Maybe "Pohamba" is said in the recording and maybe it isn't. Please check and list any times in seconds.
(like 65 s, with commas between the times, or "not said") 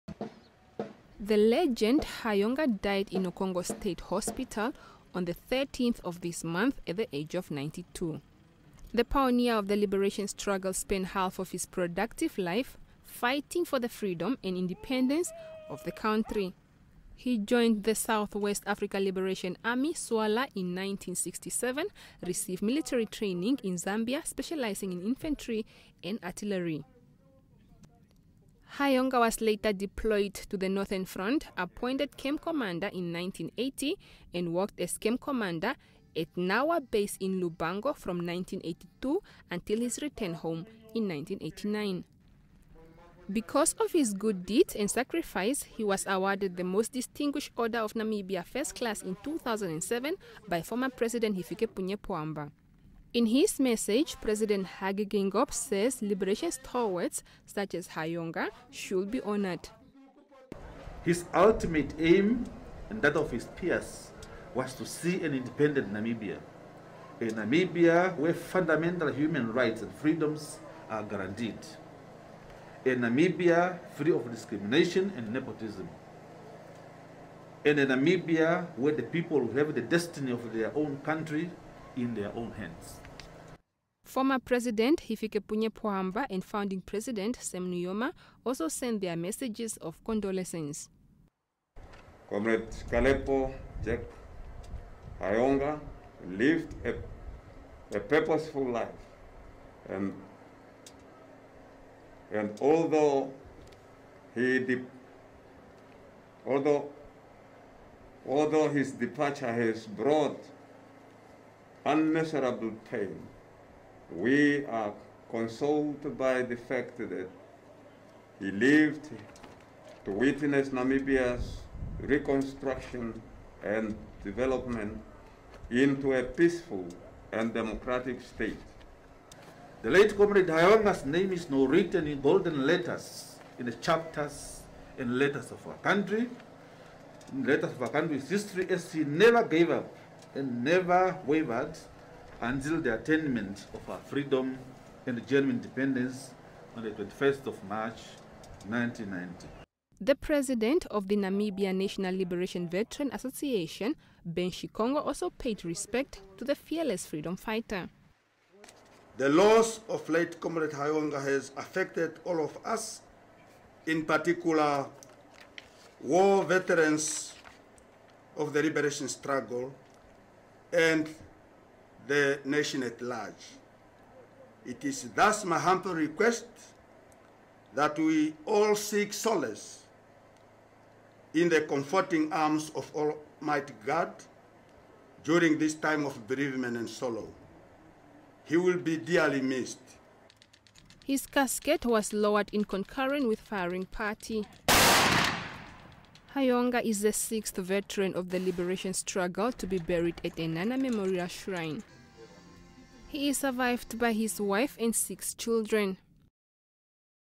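51 s, 85 s.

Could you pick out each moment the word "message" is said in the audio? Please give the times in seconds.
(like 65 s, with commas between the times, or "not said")
53 s, 89 s.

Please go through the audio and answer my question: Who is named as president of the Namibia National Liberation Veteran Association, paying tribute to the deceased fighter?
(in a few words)
Ben Shikongo.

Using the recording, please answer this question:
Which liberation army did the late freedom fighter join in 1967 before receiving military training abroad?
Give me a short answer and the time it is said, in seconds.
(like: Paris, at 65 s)
SWALA, at 19 s.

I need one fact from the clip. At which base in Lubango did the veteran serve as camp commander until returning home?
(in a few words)
Nawa base.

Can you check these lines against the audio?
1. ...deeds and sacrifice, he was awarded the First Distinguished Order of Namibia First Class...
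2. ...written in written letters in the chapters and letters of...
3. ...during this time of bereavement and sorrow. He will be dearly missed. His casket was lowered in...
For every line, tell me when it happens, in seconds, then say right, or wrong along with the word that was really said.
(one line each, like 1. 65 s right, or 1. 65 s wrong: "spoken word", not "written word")
1. 44 s wrong: "Most", not "First"
2. 131 s wrong: "golden", not "written"
3. 185 s right.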